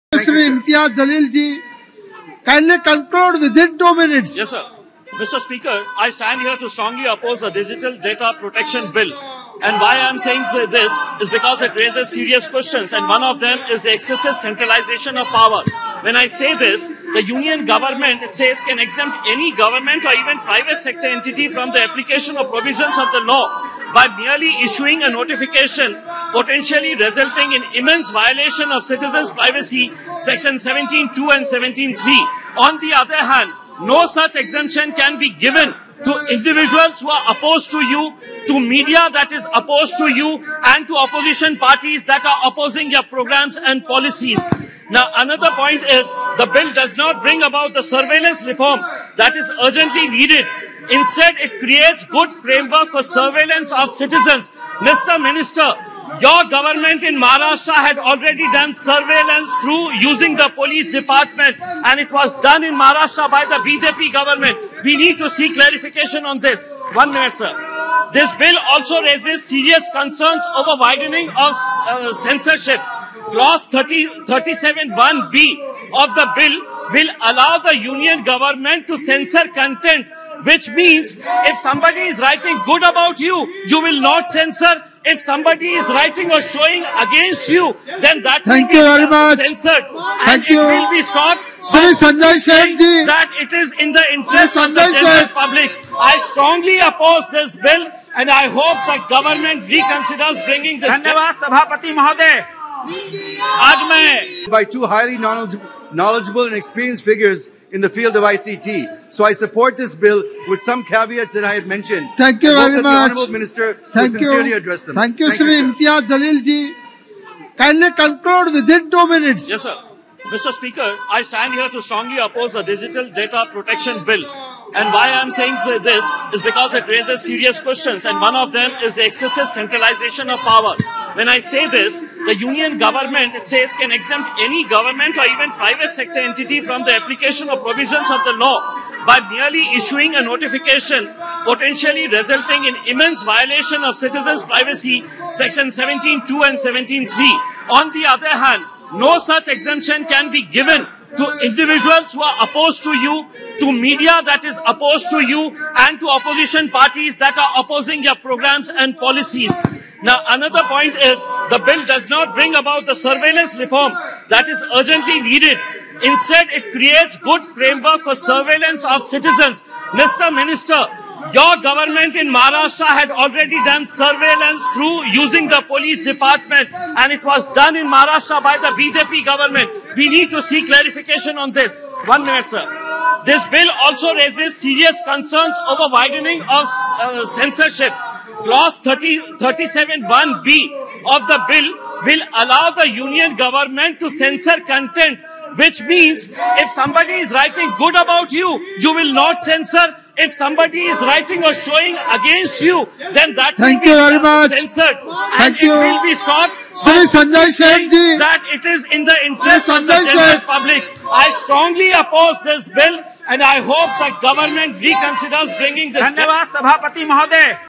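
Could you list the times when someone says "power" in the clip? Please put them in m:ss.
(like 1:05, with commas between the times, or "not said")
0:15, 2:10.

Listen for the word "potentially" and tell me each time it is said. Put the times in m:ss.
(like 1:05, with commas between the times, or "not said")
0:26, 2:21.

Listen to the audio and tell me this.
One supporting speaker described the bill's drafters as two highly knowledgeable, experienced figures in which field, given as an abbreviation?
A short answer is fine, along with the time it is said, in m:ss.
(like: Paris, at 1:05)
ICT, at 1:48.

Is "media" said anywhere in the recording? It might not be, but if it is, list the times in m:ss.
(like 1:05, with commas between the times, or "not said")
0:38, 2:33.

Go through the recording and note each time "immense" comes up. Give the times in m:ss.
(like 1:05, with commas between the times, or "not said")
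0:27, 2:22.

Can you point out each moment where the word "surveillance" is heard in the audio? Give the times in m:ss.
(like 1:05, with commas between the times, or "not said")
0:47, 0:53, 0:58, 2:42, 2:48, 2:53.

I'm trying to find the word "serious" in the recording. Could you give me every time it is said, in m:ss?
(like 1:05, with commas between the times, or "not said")
0:12, 1:09, 2:07, 3:04.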